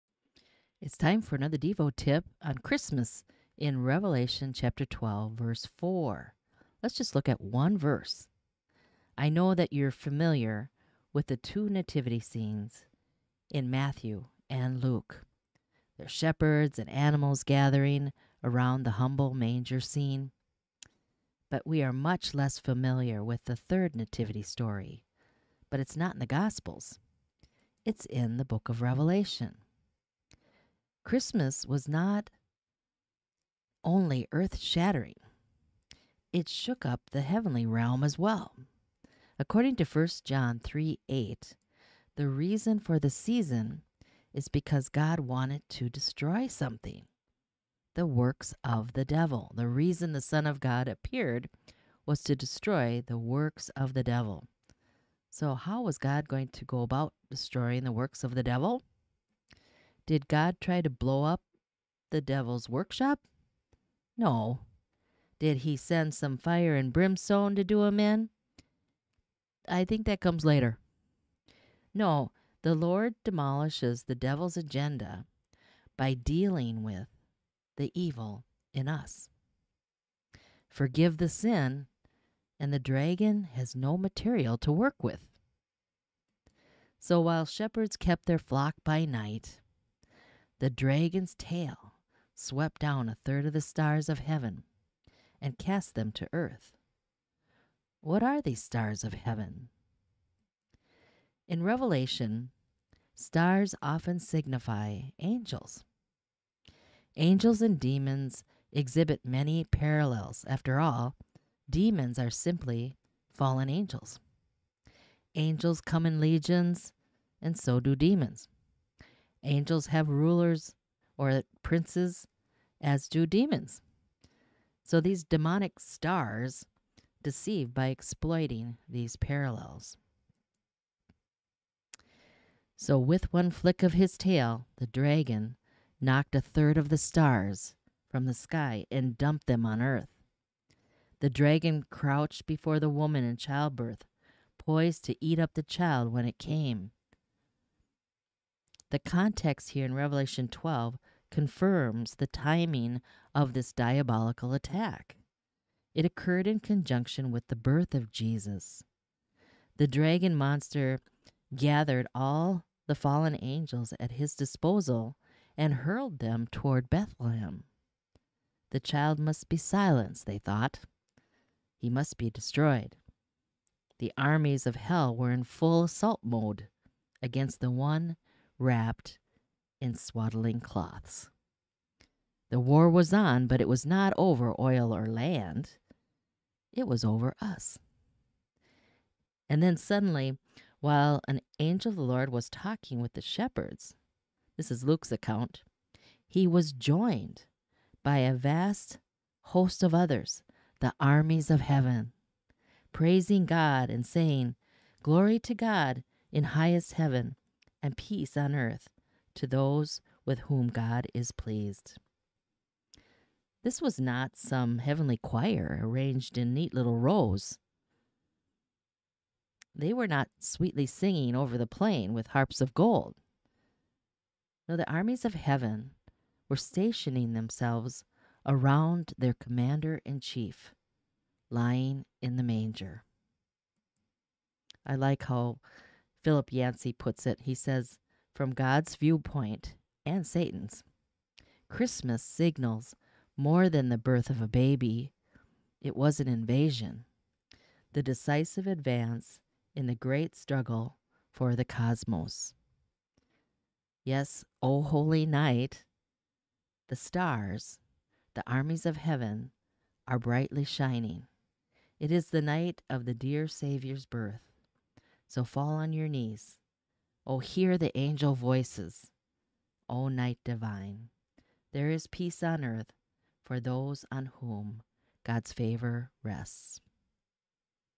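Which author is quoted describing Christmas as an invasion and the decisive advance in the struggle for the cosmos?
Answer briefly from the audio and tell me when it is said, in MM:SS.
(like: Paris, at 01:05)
Philip Yancey, at 03:56.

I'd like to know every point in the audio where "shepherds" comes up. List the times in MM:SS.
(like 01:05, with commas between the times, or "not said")
00:16, 01:27, 03:13.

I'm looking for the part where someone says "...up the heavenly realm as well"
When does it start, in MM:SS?
00:36.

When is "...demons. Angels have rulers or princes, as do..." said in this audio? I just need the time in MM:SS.
01:57.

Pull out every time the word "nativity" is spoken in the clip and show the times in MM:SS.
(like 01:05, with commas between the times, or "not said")
00:11, 00:23.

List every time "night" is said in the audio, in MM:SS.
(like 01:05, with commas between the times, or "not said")
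01:29, 04:15, 04:22, 04:30.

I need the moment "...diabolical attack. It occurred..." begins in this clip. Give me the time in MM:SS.
02:33.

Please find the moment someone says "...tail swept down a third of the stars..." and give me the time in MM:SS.
01:31.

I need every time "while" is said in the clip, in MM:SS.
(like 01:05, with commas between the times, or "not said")
01:27, 03:10.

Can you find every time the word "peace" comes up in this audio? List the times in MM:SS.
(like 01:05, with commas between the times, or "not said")
03:27, 04:32.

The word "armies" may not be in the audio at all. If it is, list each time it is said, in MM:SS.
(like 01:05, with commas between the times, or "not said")
02:54, 03:20, 03:44, 04:18.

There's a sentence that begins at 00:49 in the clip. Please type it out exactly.
The reason the Son of God appeared was to destroy the works of the devil.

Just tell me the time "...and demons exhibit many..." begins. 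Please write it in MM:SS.
01:47.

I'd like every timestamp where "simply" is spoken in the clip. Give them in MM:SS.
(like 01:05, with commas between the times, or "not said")
01:52.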